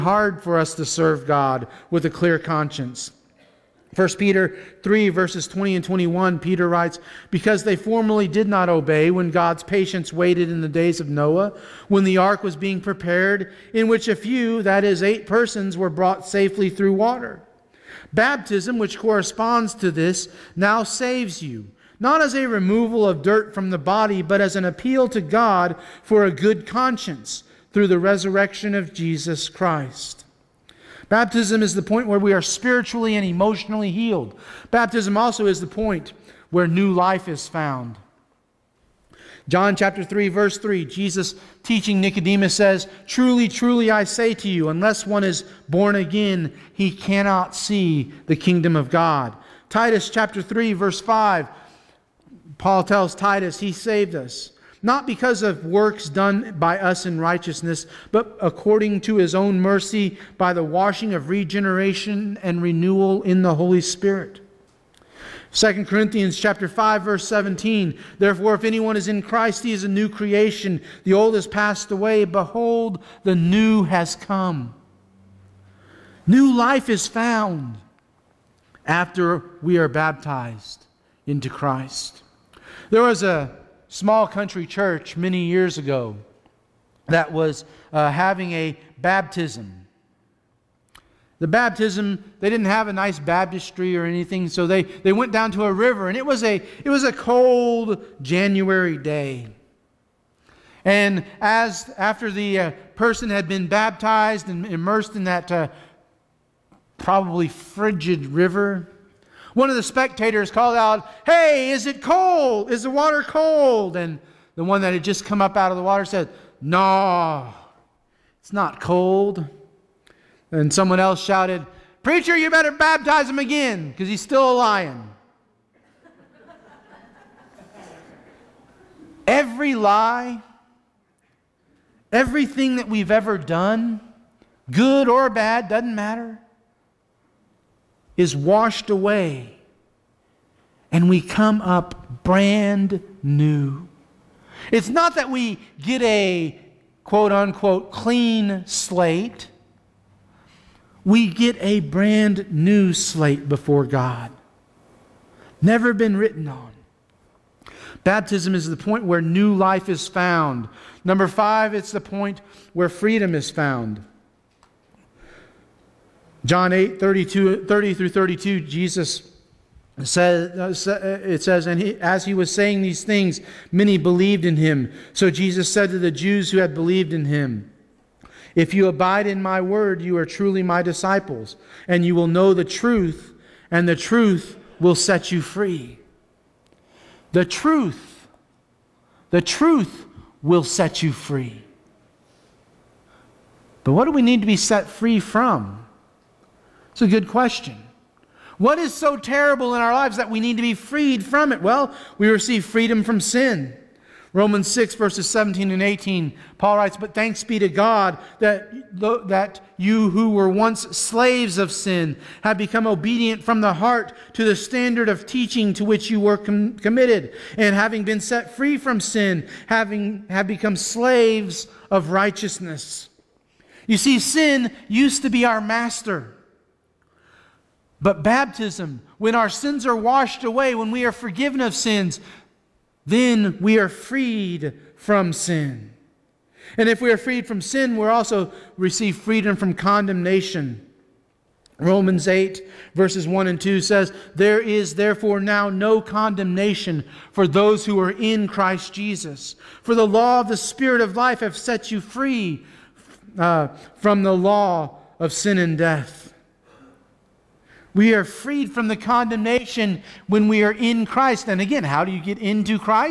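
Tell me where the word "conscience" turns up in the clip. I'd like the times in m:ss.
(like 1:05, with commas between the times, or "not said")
0:02, 0:26.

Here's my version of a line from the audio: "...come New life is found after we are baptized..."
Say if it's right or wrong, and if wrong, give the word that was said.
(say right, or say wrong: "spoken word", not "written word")
right.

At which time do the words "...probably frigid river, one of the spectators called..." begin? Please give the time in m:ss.
1:46.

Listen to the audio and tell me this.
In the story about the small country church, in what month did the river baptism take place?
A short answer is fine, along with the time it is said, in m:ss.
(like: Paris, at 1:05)
January, at 1:38.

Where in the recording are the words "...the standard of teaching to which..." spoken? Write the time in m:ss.
3:34.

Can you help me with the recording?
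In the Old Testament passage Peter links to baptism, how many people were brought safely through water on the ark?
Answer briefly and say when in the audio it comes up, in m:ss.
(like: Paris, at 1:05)
8, at 0:15.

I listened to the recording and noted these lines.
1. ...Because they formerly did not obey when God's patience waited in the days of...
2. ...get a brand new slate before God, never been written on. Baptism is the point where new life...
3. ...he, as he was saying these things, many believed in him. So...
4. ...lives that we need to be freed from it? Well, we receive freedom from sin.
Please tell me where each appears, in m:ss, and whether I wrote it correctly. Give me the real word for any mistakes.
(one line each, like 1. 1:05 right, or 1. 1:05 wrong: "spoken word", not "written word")
1. 0:07 right
2. 2:31 right
3. 2:51 right
4. 3:19 right.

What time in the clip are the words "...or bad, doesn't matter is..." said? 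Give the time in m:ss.
2:15.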